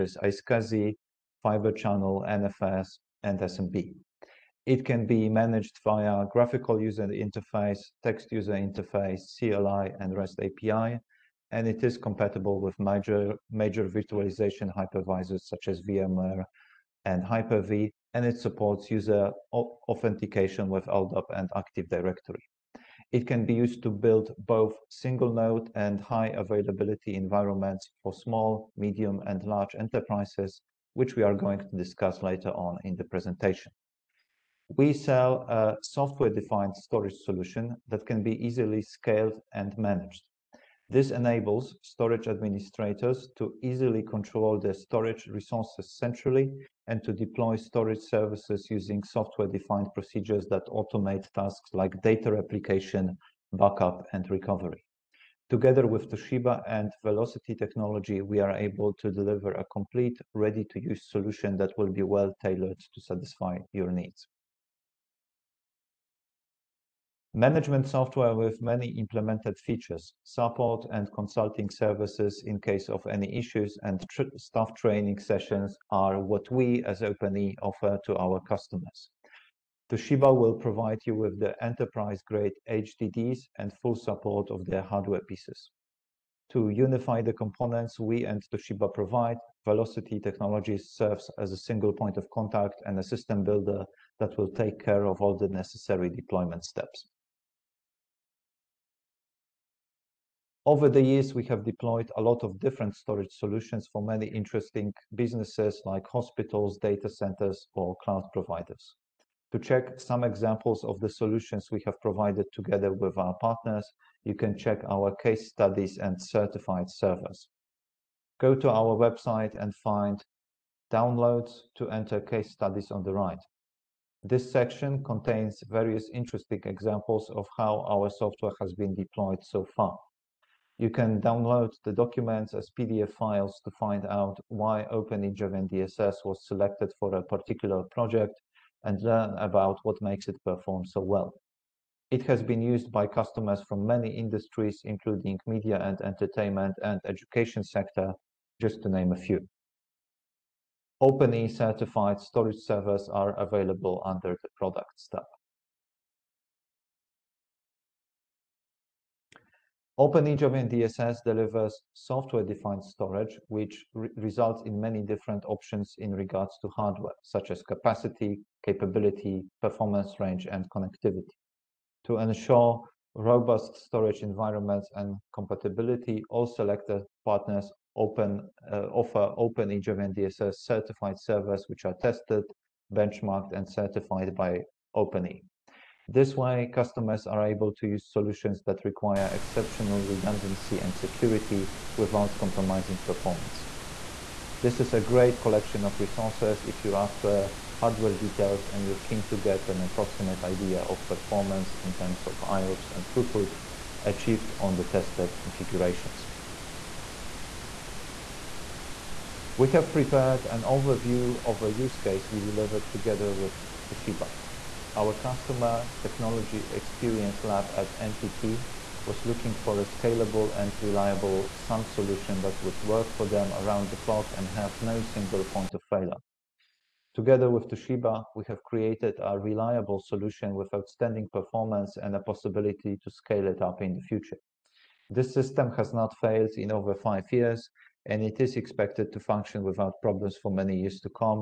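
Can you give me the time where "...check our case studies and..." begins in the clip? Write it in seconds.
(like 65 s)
114 s.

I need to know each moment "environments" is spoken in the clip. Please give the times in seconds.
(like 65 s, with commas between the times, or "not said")
27 s, 174 s.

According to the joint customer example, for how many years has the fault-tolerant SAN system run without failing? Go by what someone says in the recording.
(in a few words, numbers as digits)
5.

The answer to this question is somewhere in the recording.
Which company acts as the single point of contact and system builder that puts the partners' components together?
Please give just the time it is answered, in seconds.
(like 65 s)
89 s.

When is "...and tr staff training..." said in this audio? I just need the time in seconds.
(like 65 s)
73 s.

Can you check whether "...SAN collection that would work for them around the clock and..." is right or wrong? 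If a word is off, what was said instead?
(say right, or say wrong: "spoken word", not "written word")
wrong: "solution", not "collection".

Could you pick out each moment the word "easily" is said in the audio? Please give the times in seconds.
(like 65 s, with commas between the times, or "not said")
38 s, 43 s.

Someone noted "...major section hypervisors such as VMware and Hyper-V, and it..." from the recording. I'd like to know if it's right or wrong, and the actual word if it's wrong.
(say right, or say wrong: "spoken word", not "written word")
wrong: "virtualization", not "section".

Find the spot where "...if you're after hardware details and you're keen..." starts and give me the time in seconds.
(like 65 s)
196 s.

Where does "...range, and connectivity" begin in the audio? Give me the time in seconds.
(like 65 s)
170 s.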